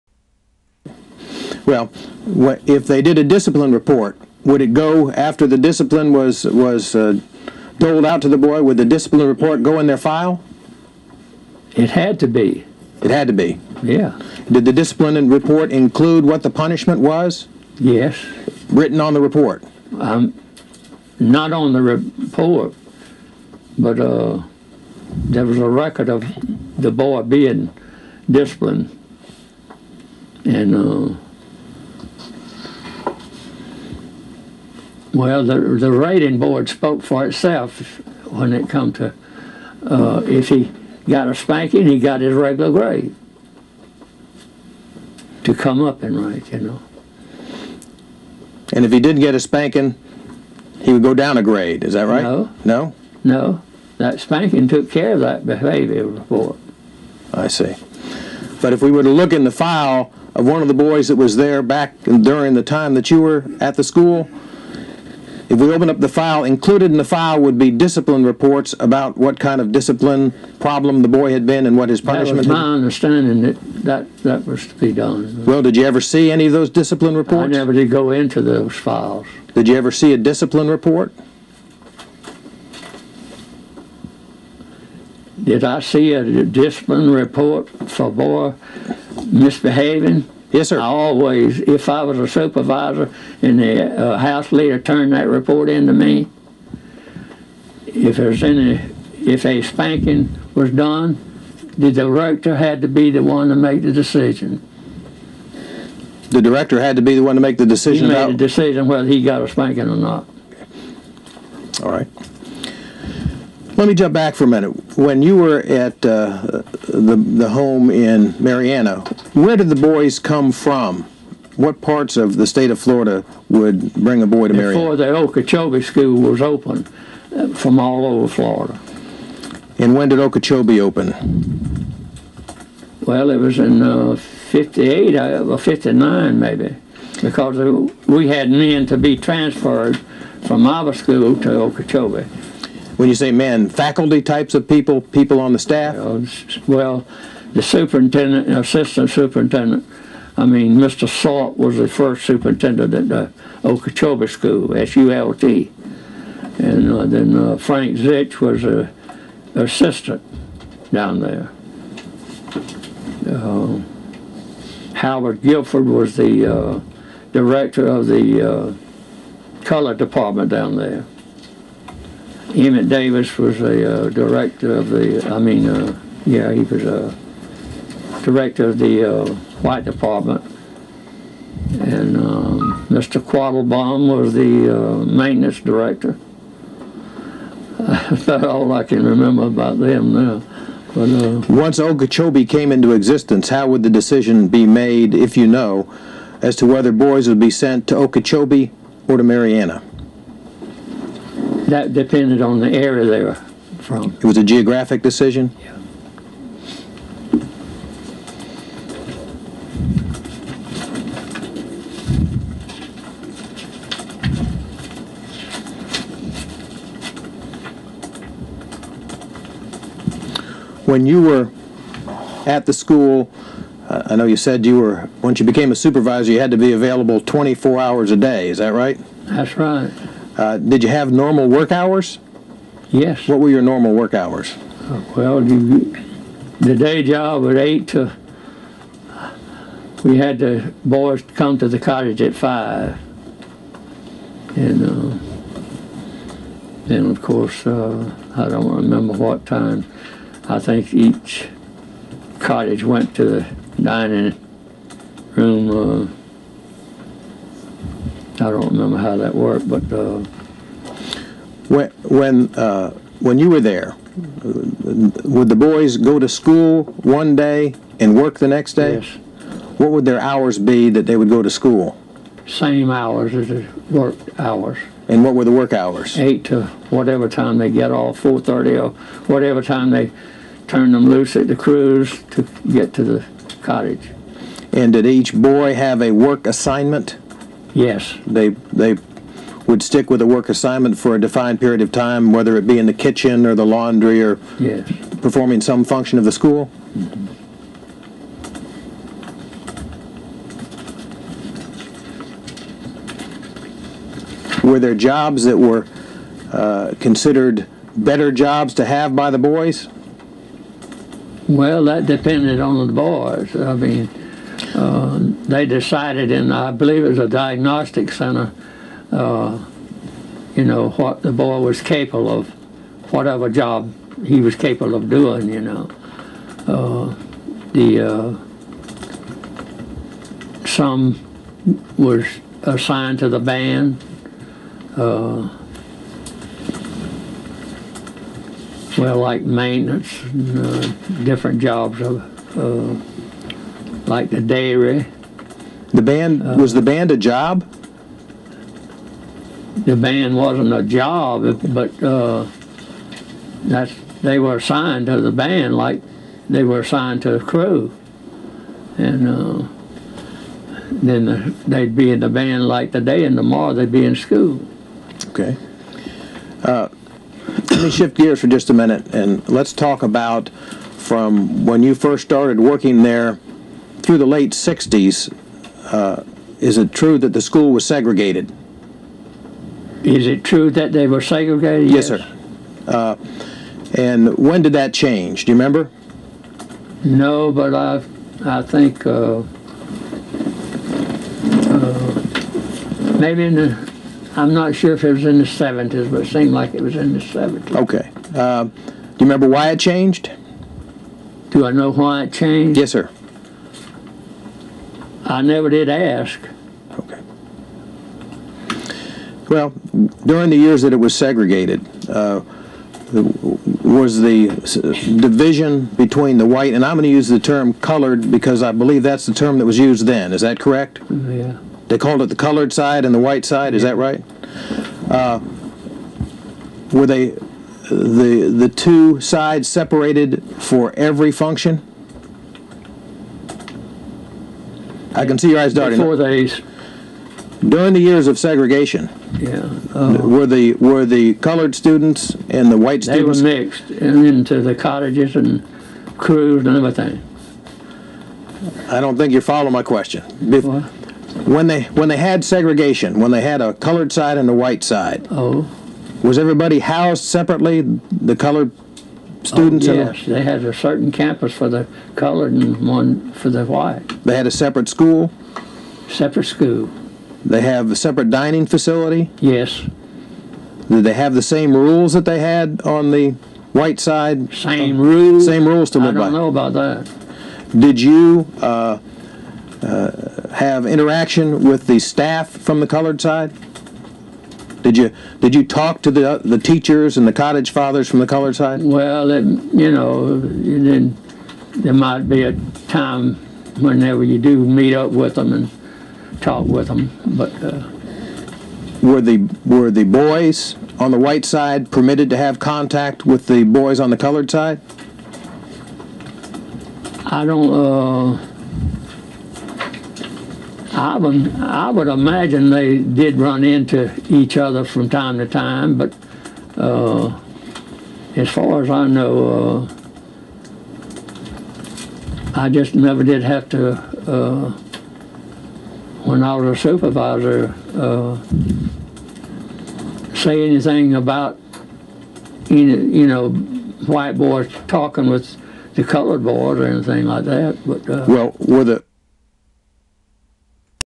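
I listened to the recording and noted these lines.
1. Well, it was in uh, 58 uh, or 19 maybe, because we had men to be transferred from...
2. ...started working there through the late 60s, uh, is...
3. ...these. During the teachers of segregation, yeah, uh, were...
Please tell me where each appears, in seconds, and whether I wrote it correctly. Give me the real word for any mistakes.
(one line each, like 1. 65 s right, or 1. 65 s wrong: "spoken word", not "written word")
1. 133 s wrong: "59", not "19"
2. 372 s right
3. 436 s wrong: "years", not "teachers".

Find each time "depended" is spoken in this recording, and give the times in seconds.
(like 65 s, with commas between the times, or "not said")
201 s, 312 s.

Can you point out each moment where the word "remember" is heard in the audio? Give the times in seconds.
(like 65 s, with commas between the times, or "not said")
189 s, 248 s, 258 s, 385 s, 399 s.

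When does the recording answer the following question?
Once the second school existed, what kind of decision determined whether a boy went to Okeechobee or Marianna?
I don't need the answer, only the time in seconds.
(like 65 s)
204 s.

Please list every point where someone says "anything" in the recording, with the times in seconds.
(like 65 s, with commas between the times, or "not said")
530 s, 536 s.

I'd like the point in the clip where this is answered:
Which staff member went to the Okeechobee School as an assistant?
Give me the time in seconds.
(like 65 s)
157 s.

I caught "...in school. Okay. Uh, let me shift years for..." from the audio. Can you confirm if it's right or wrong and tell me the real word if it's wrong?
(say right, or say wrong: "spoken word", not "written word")
wrong: "gears", not "years".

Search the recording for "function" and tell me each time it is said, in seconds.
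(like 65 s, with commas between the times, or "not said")
295 s, 431 s.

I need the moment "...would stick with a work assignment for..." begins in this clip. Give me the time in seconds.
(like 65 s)
289 s.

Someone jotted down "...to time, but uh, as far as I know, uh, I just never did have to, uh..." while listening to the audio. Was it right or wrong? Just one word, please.
right.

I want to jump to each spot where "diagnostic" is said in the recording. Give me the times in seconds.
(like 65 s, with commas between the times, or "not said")
317 s.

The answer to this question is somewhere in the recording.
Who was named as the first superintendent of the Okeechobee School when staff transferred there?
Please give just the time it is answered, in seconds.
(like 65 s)
150 s.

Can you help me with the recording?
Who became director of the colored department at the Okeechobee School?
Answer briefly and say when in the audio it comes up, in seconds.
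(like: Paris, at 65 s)
Howard Guilford, at 164 s.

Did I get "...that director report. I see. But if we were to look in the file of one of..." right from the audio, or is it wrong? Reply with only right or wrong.
wrong.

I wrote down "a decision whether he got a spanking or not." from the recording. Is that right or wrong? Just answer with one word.
right.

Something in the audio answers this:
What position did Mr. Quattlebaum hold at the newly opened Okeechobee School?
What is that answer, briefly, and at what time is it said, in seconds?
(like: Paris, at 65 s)
Maintenance director, at 185 s.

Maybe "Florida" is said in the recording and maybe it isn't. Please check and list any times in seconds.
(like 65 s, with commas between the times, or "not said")
122 s, 128 s.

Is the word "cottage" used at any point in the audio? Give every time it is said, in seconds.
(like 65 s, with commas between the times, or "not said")
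241 s, 252 s, 283 s, 444 s, 487 s.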